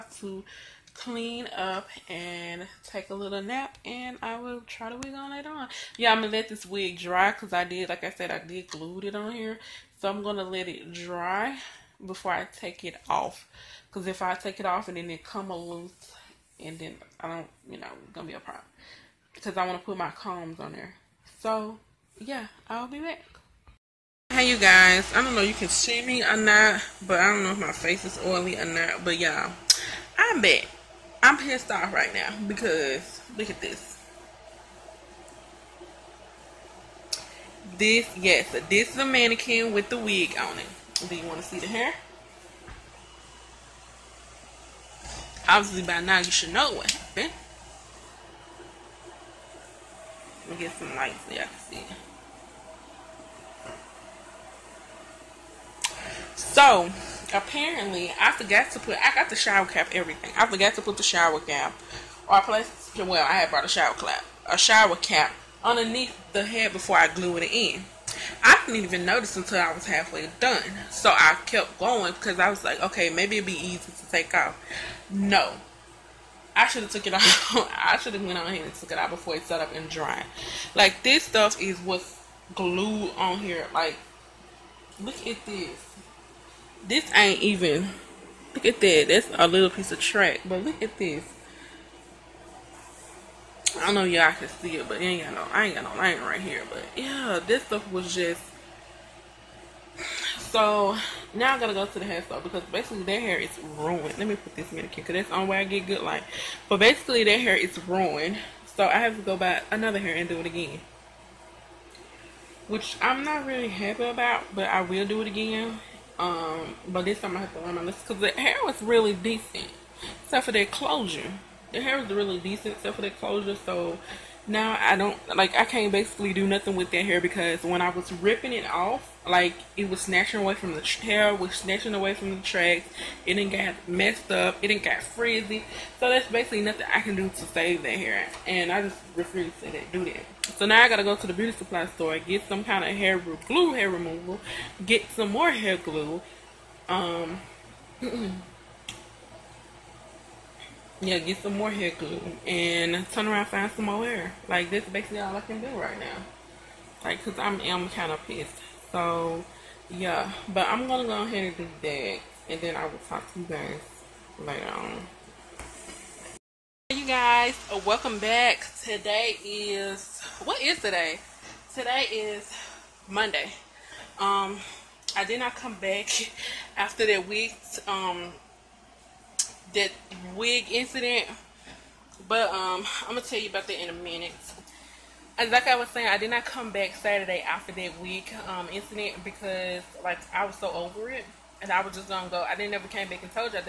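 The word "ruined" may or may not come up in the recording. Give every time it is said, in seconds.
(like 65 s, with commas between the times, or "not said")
103 s, 107 s.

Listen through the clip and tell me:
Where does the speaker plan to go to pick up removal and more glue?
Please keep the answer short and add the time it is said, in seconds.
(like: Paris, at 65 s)
beauty supply store, at 141 s.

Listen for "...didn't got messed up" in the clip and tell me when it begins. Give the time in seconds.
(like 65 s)
133 s.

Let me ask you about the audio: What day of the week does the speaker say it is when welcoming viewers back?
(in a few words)
Monday.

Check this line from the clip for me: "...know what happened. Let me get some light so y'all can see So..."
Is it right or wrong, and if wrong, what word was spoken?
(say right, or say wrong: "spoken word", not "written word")
right.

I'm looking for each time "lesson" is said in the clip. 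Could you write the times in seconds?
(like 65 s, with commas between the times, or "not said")
117 s.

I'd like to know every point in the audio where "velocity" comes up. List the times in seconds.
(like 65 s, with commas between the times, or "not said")
not said.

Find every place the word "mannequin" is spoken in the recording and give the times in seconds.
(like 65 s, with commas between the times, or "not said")
39 s, 104 s.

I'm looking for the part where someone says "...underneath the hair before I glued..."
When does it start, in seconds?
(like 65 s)
65 s.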